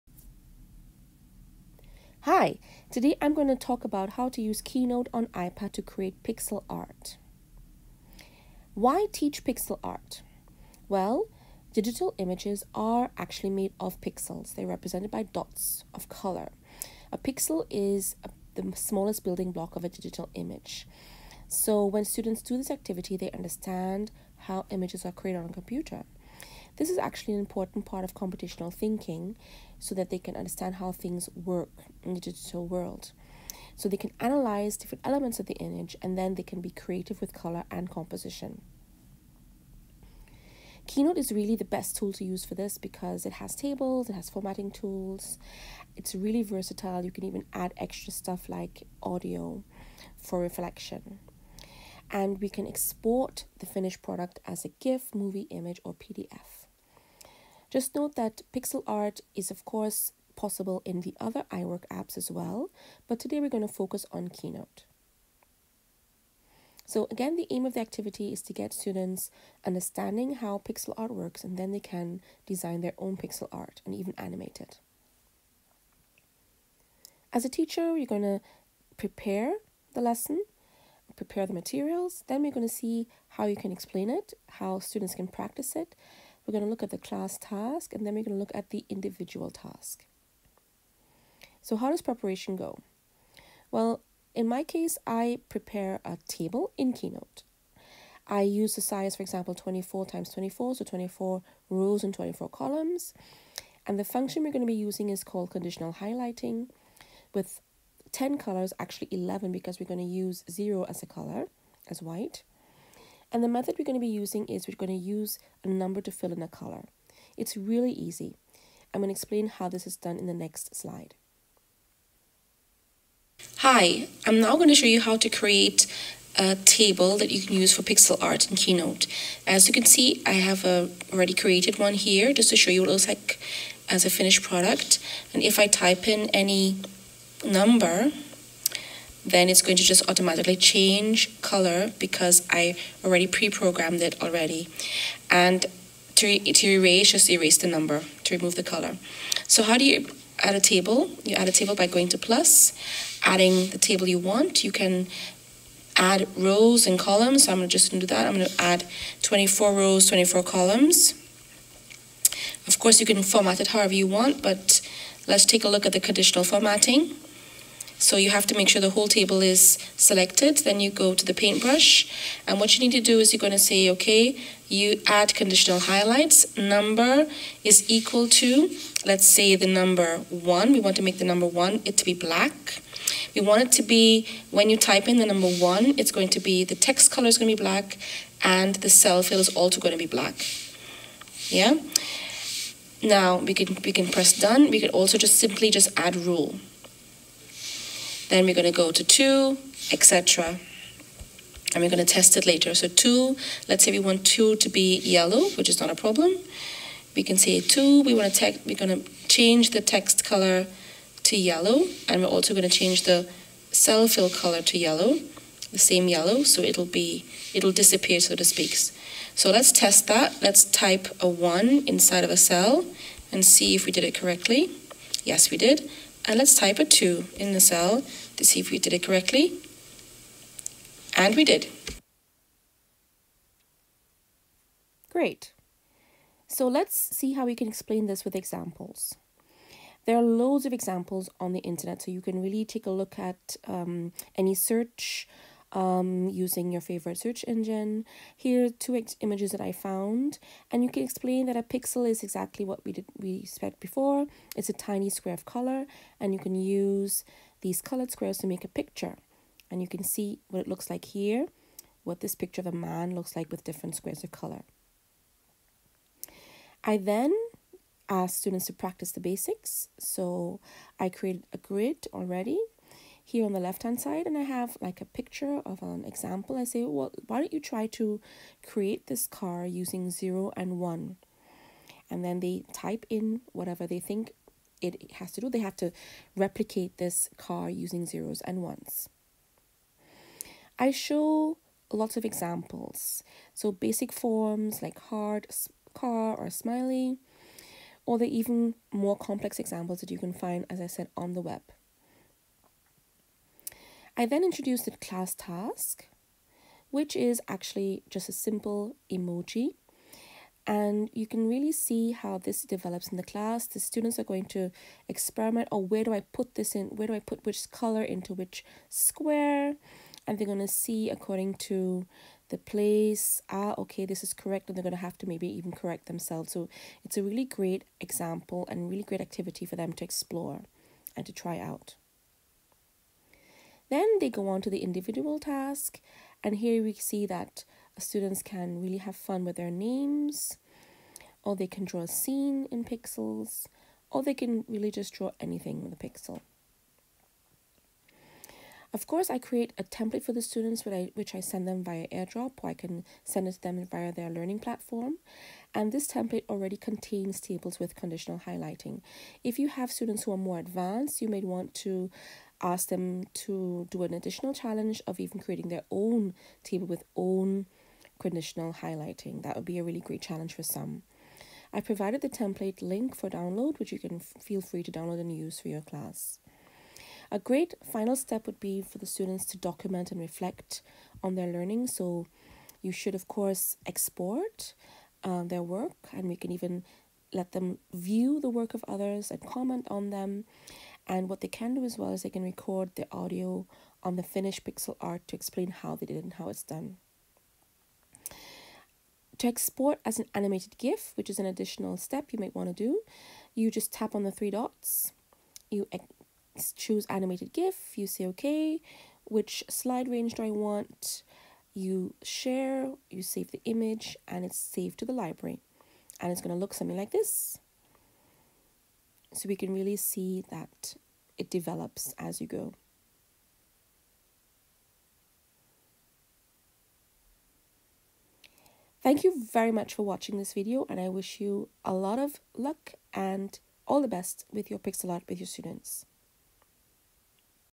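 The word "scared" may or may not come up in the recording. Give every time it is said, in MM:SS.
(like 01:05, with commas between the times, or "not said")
not said.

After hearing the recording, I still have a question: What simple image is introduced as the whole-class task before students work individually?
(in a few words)
emoji.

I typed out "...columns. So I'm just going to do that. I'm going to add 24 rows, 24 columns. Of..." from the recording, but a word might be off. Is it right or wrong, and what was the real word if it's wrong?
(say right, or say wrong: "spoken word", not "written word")
right.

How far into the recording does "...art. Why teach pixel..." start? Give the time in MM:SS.
00:06.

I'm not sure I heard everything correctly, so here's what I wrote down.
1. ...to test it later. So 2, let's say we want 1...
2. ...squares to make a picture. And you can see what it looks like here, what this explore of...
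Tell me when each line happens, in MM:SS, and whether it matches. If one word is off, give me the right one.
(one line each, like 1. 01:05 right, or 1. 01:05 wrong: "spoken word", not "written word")
1. 03:22 wrong: "2", not "1"
2. 04:18 wrong: "picture", not "explore".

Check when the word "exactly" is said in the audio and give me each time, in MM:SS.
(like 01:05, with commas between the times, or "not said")
04:12.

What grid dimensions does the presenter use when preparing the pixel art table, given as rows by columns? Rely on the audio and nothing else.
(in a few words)
24 by 24.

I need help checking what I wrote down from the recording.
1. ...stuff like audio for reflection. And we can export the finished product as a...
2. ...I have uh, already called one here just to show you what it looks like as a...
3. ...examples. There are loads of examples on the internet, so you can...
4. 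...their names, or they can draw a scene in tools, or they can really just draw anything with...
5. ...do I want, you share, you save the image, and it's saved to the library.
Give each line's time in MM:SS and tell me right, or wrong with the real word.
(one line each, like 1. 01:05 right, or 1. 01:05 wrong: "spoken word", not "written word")
1. 00:48 right
2. 02:10 wrong: "created", not "called"
3. 03:58 right
4. 05:39 wrong: "pixels", not "tools"
5. 06:50 right.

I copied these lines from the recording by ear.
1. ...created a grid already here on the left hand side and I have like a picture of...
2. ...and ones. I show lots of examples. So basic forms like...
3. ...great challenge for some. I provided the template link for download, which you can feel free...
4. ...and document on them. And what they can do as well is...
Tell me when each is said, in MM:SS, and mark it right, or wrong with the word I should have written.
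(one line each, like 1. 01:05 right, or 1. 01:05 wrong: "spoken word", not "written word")
1. 04:31 right
2. 04:48 right
3. 06:09 right
4. 06:29 wrong: "comment", not "document".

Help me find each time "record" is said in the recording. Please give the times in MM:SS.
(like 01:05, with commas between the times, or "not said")
06:32.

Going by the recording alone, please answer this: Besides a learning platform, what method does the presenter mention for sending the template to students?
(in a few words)
AirDrop.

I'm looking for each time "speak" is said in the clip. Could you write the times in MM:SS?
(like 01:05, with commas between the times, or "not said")
03:38.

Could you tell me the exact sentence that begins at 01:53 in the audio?
And the method we're going to be using is we're going to use a number to fill in a color.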